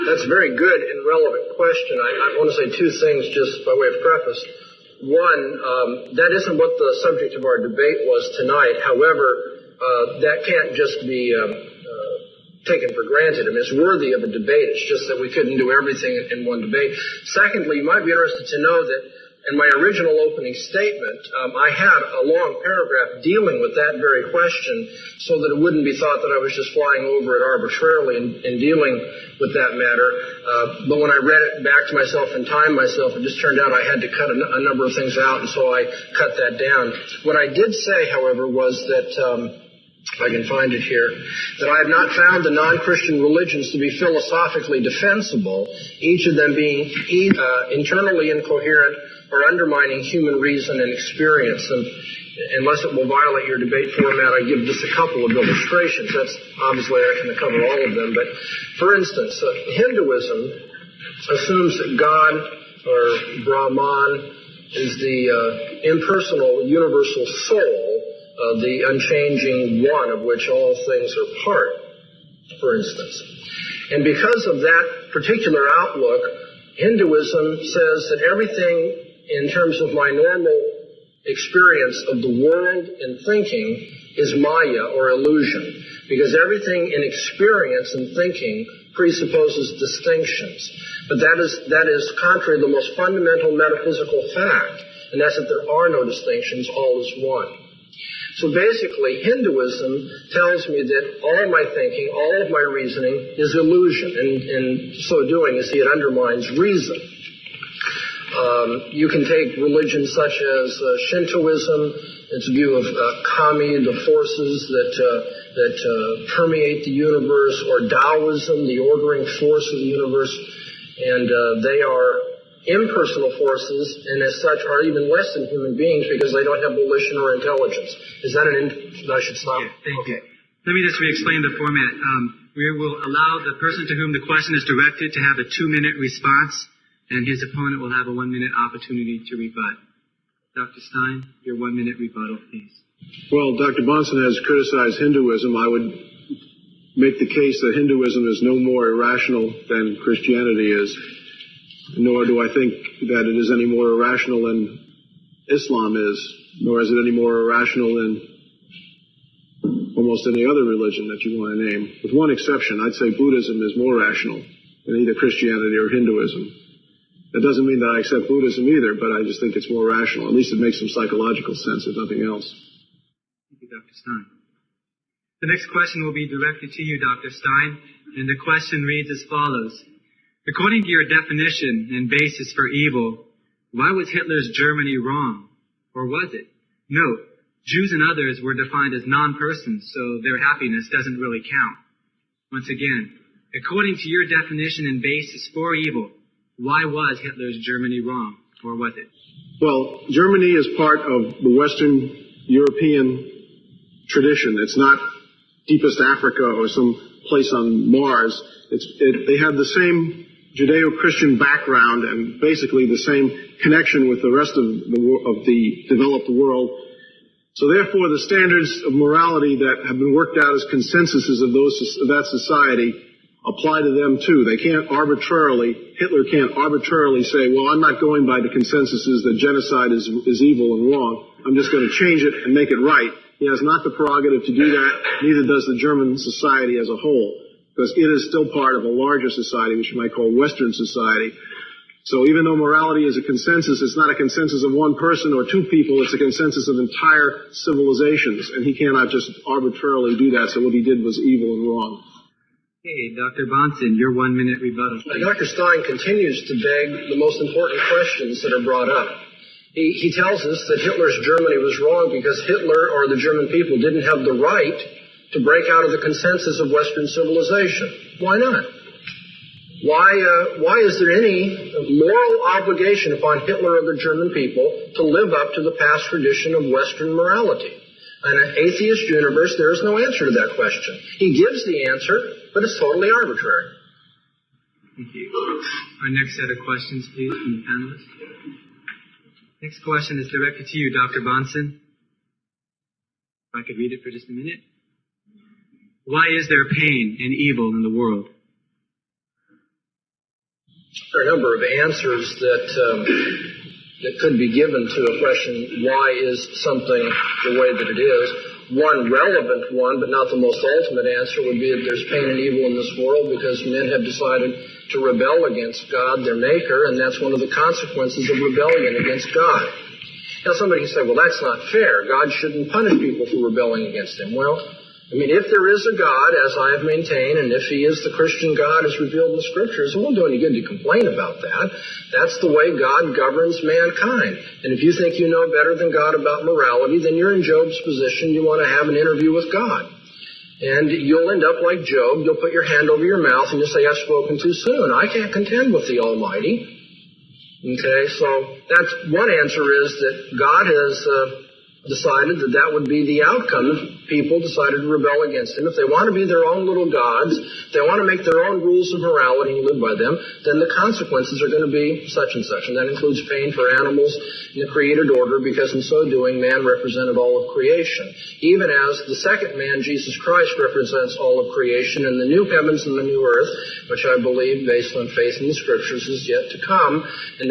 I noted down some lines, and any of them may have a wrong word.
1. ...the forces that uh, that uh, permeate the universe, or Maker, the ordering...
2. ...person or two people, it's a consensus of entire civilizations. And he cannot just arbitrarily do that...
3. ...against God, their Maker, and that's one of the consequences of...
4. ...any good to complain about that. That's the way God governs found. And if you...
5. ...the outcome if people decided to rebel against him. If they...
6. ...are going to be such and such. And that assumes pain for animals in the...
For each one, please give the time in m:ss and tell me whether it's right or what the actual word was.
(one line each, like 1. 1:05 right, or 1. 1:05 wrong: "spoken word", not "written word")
1. 1:53 wrong: "Taoism", not "Maker"
2. 4:04 right
3. 5:15 right
4. 5:30 wrong: "mankind", not "found"
5. 5:53 right
6. 6:01 wrong: "includes", not "assumes".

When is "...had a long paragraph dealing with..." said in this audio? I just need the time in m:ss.
0:21.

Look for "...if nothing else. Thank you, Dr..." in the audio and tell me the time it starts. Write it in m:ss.
2:51.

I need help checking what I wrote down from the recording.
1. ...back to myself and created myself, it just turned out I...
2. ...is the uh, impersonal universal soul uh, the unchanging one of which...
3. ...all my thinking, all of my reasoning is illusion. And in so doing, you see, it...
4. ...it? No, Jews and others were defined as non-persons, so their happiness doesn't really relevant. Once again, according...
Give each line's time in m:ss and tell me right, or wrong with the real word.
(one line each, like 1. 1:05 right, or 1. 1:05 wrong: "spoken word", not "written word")
1. 0:31 wrong: "timed", not "created"
2. 1:04 right
3. 1:41 right
4. 3:06 wrong: "count", not "relevant".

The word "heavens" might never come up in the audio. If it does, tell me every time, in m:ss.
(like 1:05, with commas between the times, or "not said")
6:12.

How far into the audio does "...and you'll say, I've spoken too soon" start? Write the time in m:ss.
5:43.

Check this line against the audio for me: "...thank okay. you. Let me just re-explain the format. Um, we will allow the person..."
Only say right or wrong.
right.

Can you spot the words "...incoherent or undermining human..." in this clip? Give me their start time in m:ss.
0:48.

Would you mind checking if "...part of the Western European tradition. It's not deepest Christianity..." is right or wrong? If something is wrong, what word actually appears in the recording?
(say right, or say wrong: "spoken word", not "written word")
wrong: "Africa", not "Christianity".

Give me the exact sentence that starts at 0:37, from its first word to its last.
What I did say, however, was that.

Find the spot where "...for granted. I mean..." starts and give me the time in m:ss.
0:12.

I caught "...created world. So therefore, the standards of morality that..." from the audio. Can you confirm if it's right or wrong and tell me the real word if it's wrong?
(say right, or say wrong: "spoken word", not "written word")
wrong: "developed", not "created".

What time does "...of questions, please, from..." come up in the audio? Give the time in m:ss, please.
4:46.